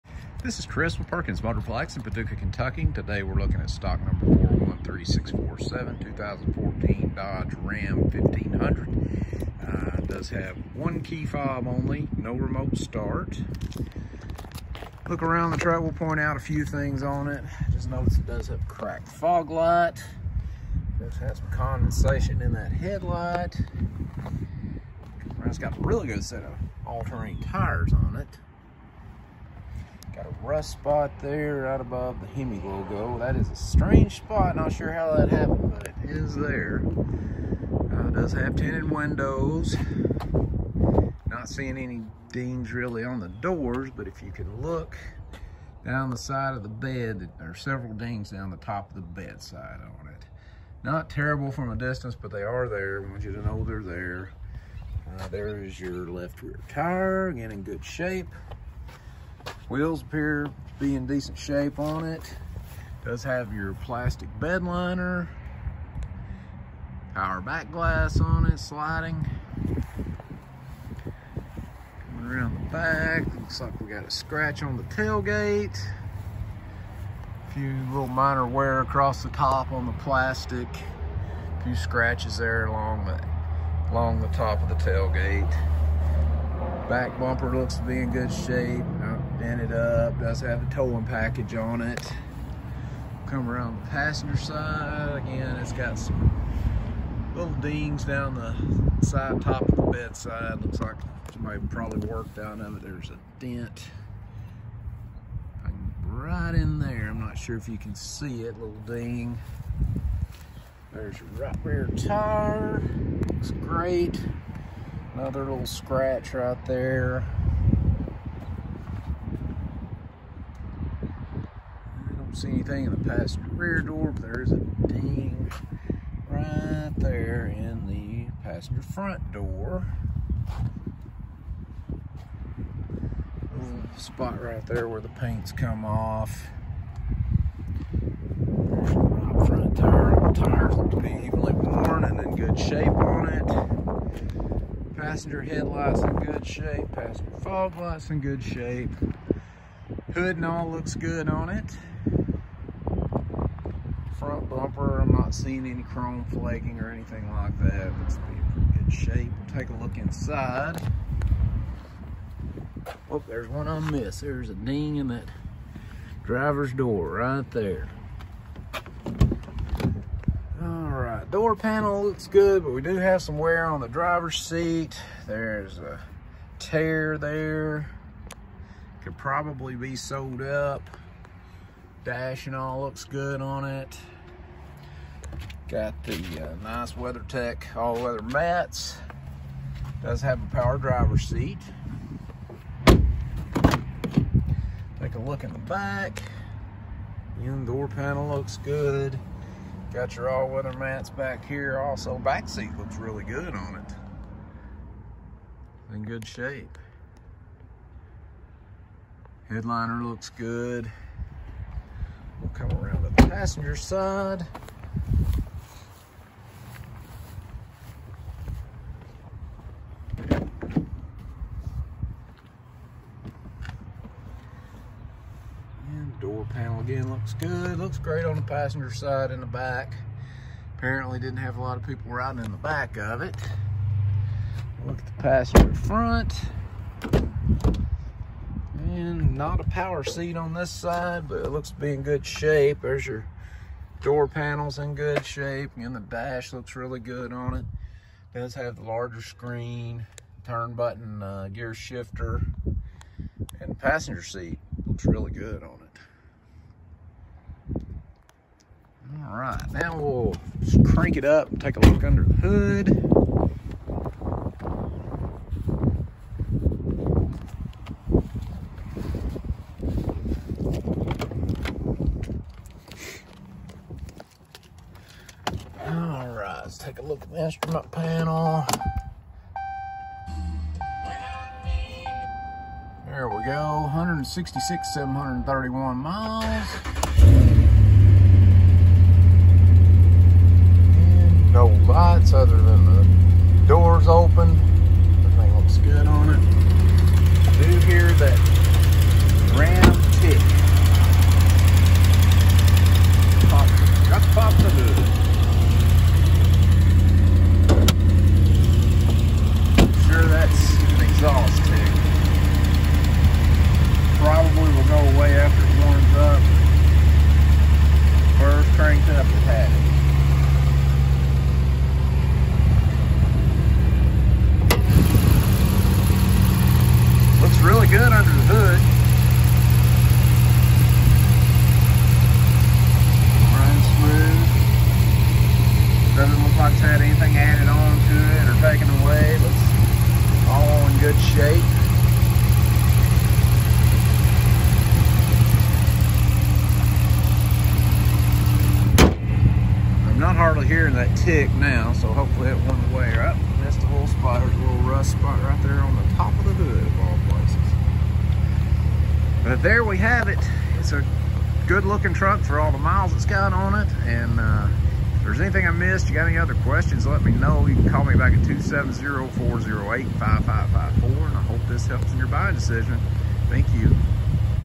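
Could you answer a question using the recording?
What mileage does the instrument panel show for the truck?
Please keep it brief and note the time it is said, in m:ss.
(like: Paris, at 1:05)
166,731 miles, at 4:43.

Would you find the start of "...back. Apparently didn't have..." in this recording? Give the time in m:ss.
3:49.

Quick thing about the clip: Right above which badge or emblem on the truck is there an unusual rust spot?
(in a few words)
Hemi.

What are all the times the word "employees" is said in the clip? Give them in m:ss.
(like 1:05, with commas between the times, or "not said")
not said.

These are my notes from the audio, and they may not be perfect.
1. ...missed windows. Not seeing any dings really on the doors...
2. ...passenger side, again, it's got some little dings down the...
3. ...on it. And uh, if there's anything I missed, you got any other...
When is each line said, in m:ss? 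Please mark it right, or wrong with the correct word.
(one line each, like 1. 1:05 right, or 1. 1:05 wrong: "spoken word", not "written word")
1. 0:38 wrong: "tinted", not "missed"
2. 1:33 right
3. 6:03 right.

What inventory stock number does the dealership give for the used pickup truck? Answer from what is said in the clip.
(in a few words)
413647.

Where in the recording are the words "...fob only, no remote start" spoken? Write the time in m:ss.
0:11.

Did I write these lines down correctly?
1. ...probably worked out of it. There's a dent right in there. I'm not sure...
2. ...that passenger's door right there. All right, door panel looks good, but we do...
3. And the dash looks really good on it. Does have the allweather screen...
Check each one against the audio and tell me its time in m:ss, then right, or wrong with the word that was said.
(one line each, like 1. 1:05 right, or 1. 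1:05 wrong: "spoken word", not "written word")
1. 1:41 right
2. 2:45 wrong: "driver", not "passenger"
3. 4:05 wrong: "larger", not "allweather".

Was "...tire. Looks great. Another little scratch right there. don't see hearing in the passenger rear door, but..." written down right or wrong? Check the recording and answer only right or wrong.
wrong.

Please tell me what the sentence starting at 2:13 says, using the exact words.
Little spot right there where the paint's come off.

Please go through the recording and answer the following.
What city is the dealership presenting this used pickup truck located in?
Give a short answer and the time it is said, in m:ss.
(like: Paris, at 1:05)
Paducah, at 0:02.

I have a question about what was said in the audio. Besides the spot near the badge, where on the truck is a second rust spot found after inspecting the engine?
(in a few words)
top of the hood.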